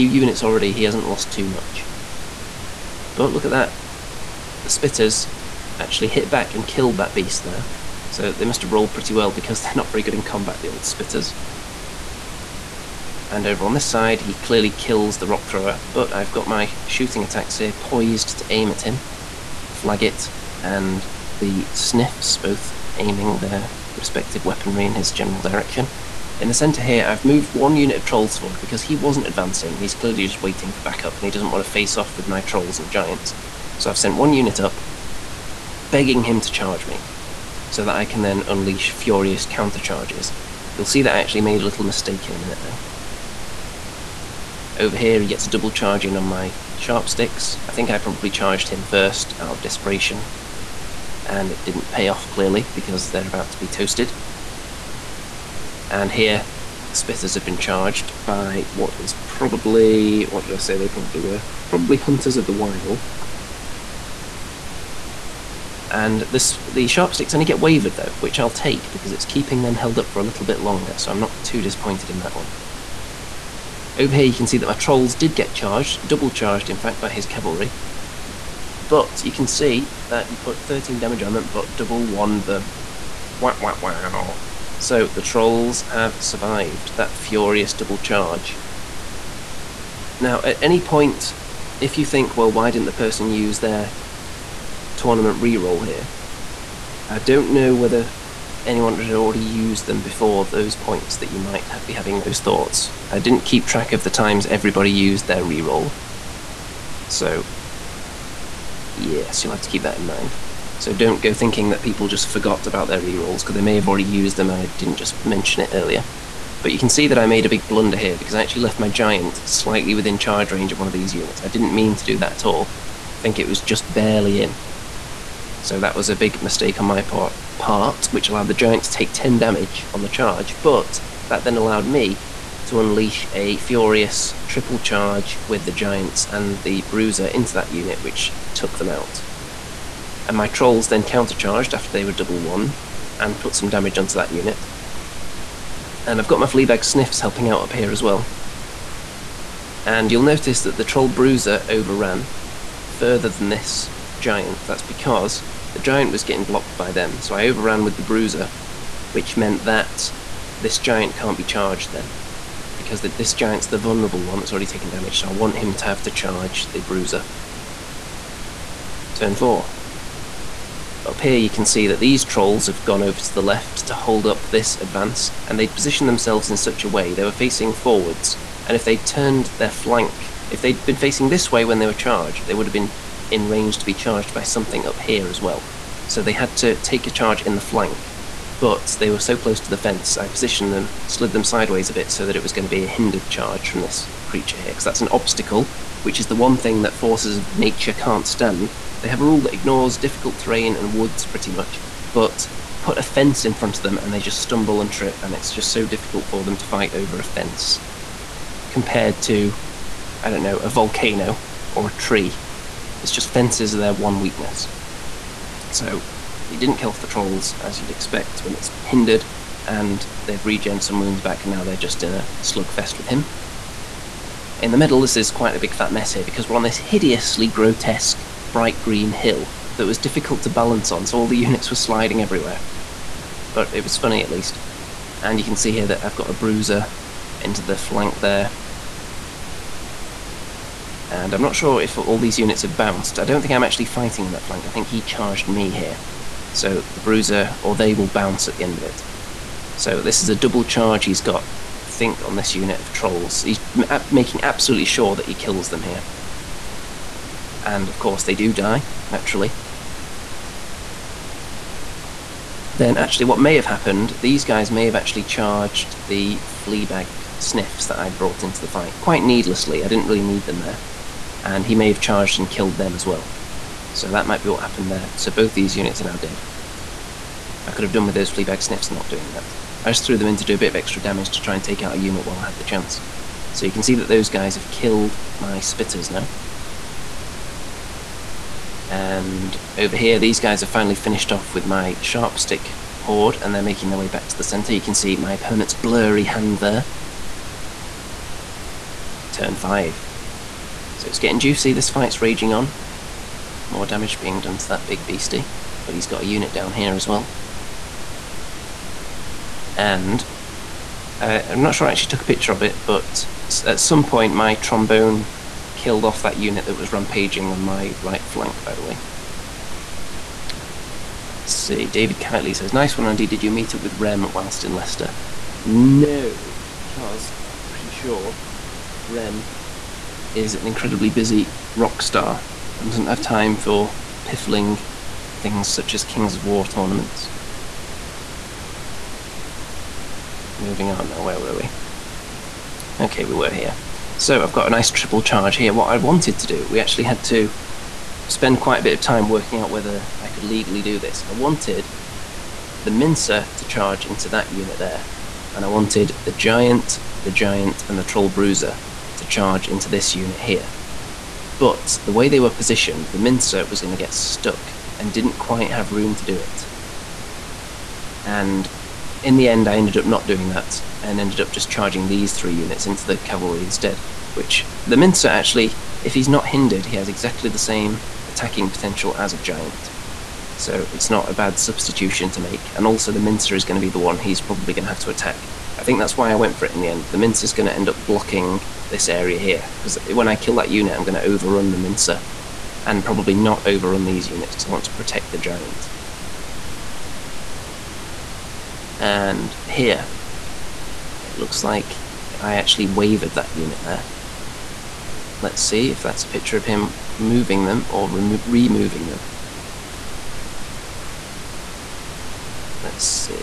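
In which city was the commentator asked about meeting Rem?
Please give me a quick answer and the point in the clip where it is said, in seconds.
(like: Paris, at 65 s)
Leicester, at 324 s.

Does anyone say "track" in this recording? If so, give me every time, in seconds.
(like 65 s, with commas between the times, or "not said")
103 s.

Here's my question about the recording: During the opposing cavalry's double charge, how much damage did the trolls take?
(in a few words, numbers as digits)
13.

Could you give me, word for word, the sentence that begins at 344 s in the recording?
So I've got a nice triple charge here.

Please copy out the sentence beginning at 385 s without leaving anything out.
I think that's why I went for it in the end.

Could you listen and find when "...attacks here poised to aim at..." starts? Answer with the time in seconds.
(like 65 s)
17 s.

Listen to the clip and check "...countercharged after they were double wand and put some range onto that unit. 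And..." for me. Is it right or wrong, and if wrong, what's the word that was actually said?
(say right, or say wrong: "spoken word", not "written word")
wrong: "damage", not "range".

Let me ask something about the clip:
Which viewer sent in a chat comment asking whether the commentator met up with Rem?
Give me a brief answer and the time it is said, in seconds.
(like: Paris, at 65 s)
David Catley, at 321 s.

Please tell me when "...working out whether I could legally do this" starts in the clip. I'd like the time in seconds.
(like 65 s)
349 s.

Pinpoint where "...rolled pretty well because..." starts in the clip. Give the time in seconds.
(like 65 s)
8 s.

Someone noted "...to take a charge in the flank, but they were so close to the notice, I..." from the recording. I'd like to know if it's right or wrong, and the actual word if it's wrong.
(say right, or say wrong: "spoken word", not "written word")
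wrong: "fence", not "notice".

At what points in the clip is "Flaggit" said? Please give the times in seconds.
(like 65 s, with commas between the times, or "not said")
19 s.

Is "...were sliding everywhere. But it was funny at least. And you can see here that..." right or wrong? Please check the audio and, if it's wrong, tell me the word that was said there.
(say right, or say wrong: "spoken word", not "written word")
right.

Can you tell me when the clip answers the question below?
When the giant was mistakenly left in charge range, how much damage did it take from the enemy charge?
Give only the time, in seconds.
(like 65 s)
129 s.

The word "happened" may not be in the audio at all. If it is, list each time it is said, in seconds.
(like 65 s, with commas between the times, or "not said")
263 s, 274 s.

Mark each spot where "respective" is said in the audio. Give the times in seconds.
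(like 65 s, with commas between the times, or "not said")
23 s.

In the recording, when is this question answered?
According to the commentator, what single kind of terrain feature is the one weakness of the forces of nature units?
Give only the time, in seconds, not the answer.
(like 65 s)
213 s.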